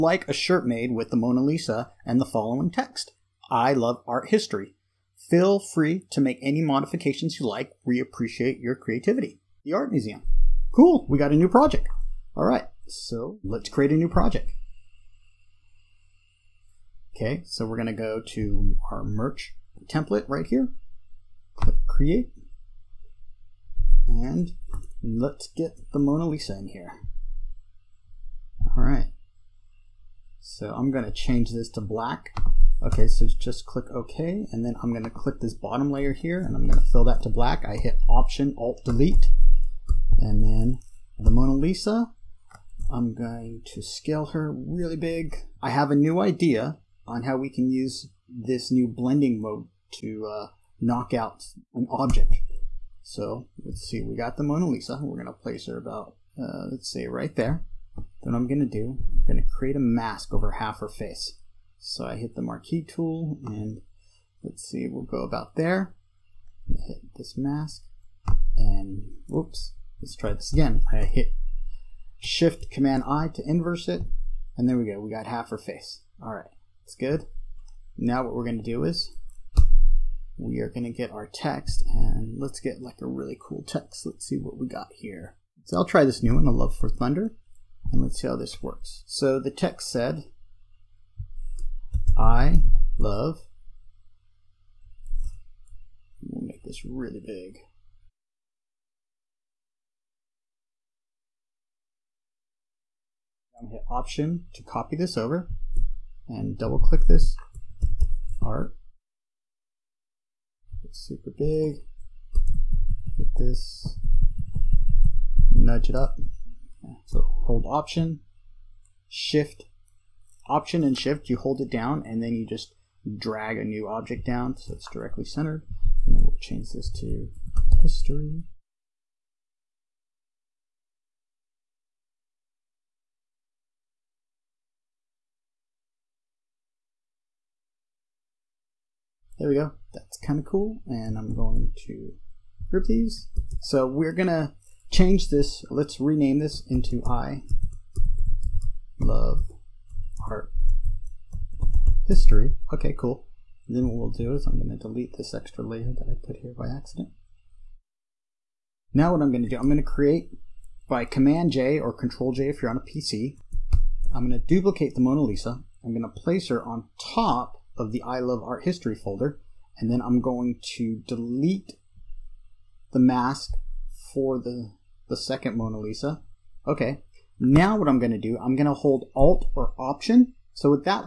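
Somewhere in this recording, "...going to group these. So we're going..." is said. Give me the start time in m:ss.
2:21.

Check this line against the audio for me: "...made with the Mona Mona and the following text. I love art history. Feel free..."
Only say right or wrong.
wrong.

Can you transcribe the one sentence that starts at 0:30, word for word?
So I'm going to change this to black.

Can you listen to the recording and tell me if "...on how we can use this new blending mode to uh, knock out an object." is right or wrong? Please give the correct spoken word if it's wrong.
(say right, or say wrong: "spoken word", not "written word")
right.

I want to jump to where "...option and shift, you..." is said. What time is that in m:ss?
2:00.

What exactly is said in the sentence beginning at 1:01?
So I hit the marquee tool and let's see, we'll go about there.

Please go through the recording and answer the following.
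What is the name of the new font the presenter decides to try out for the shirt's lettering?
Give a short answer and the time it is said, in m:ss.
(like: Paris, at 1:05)
A Love for Thunder, at 1:26.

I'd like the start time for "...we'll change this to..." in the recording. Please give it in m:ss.
2:06.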